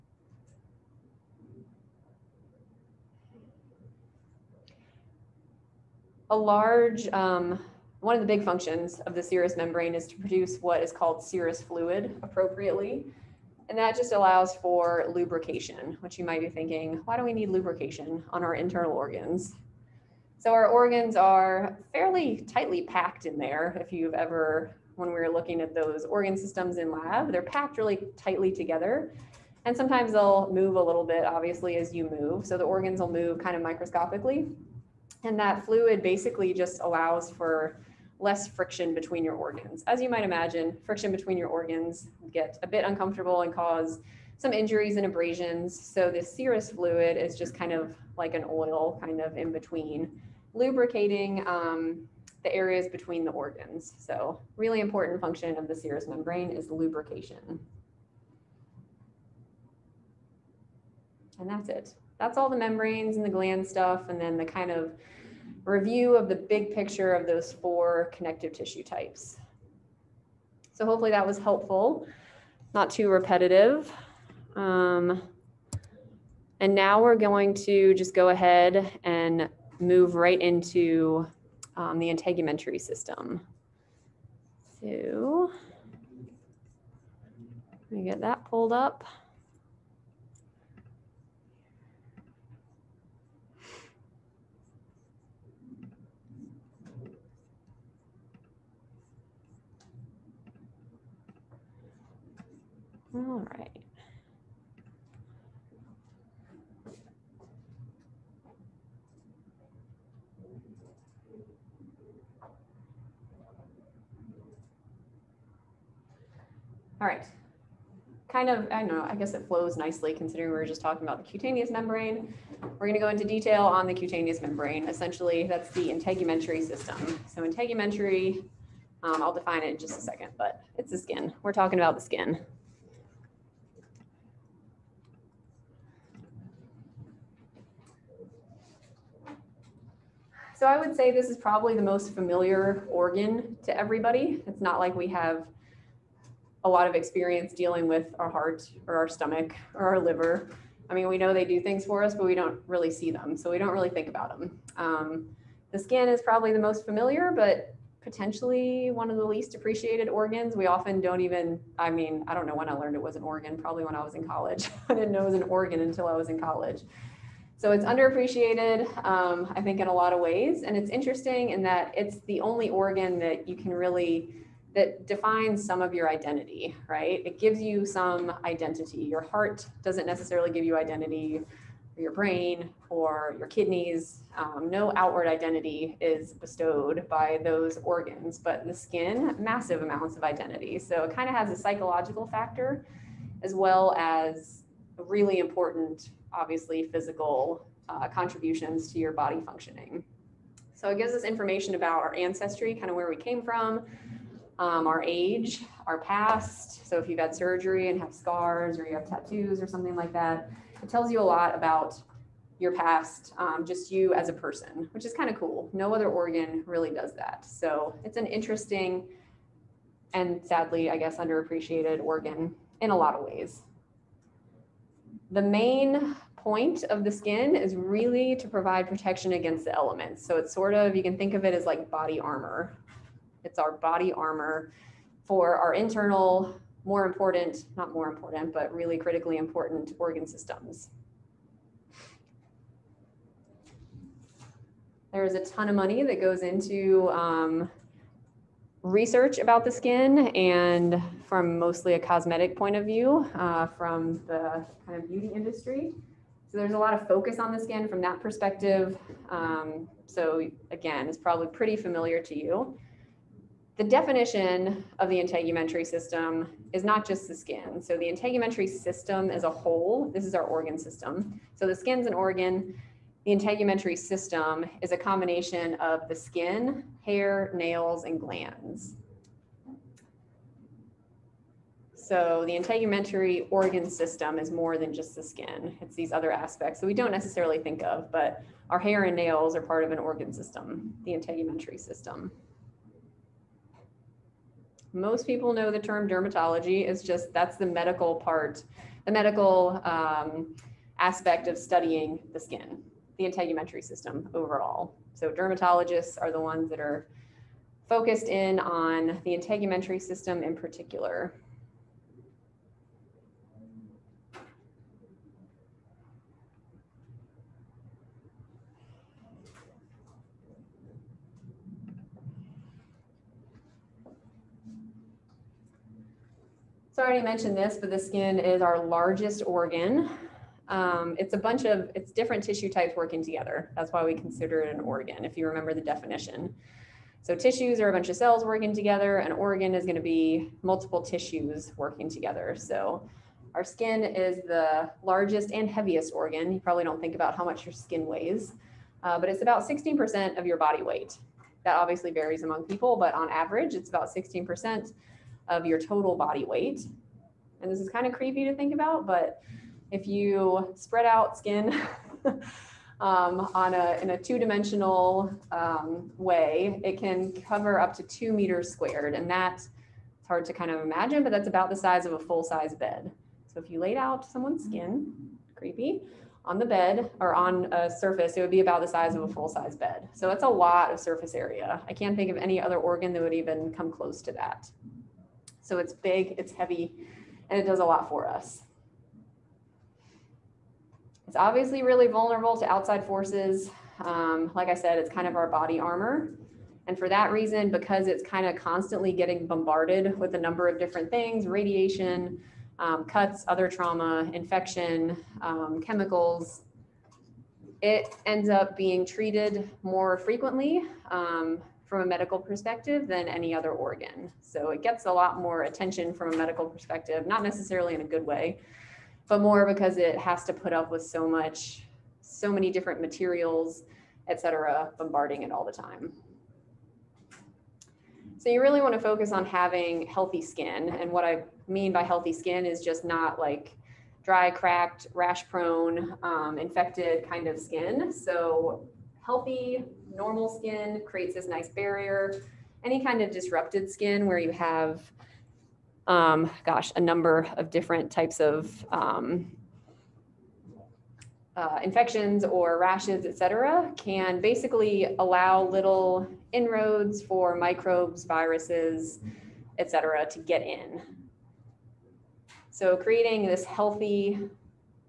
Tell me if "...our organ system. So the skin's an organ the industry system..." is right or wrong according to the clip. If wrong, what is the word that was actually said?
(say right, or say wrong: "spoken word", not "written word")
wrong: "integumentary", not "industry".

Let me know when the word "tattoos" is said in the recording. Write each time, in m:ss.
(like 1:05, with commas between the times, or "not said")
3:29.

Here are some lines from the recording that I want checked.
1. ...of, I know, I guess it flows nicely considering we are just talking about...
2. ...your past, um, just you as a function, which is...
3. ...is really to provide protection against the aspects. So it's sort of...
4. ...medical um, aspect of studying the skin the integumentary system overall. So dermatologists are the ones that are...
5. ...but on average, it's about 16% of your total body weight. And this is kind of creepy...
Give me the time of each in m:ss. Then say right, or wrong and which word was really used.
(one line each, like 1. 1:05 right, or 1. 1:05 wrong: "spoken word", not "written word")
1. 1:58 right
2. 3:32 wrong: "person", not "function"
3. 3:47 wrong: "elements", not "aspects"
4. 4:59 right
5. 5:52 right.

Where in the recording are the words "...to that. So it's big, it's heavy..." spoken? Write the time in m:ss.
6:24.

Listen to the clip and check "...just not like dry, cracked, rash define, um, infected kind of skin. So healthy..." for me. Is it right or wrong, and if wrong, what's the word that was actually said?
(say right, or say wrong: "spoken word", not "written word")
wrong: "prone", not "define".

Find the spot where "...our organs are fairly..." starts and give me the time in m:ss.
0:20.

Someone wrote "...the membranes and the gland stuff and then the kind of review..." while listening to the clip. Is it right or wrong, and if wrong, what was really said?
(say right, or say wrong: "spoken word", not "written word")
right.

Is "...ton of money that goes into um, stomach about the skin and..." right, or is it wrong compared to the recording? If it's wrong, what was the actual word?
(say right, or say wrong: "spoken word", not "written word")
wrong: "research", not "stomach".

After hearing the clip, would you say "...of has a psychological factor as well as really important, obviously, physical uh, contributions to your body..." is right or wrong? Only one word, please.
right.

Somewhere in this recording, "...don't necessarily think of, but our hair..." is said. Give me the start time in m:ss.
4:46.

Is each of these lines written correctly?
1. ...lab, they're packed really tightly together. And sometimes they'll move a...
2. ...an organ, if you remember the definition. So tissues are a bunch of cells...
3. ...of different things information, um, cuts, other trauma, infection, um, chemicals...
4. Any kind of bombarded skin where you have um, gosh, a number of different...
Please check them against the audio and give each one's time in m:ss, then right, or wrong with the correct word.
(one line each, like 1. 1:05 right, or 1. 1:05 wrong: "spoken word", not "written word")
1. 0:26 right
2. 5:34 right
3. 6:40 wrong: "radiation", not "information"
4. 7:22 wrong: "disrupted", not "bombarded".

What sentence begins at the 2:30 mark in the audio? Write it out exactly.
I mean, we know they do things for us, but we don't really see them.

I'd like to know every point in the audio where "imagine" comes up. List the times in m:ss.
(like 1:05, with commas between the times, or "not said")
0:40, 6:10.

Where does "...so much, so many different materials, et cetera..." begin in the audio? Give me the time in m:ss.
7:01.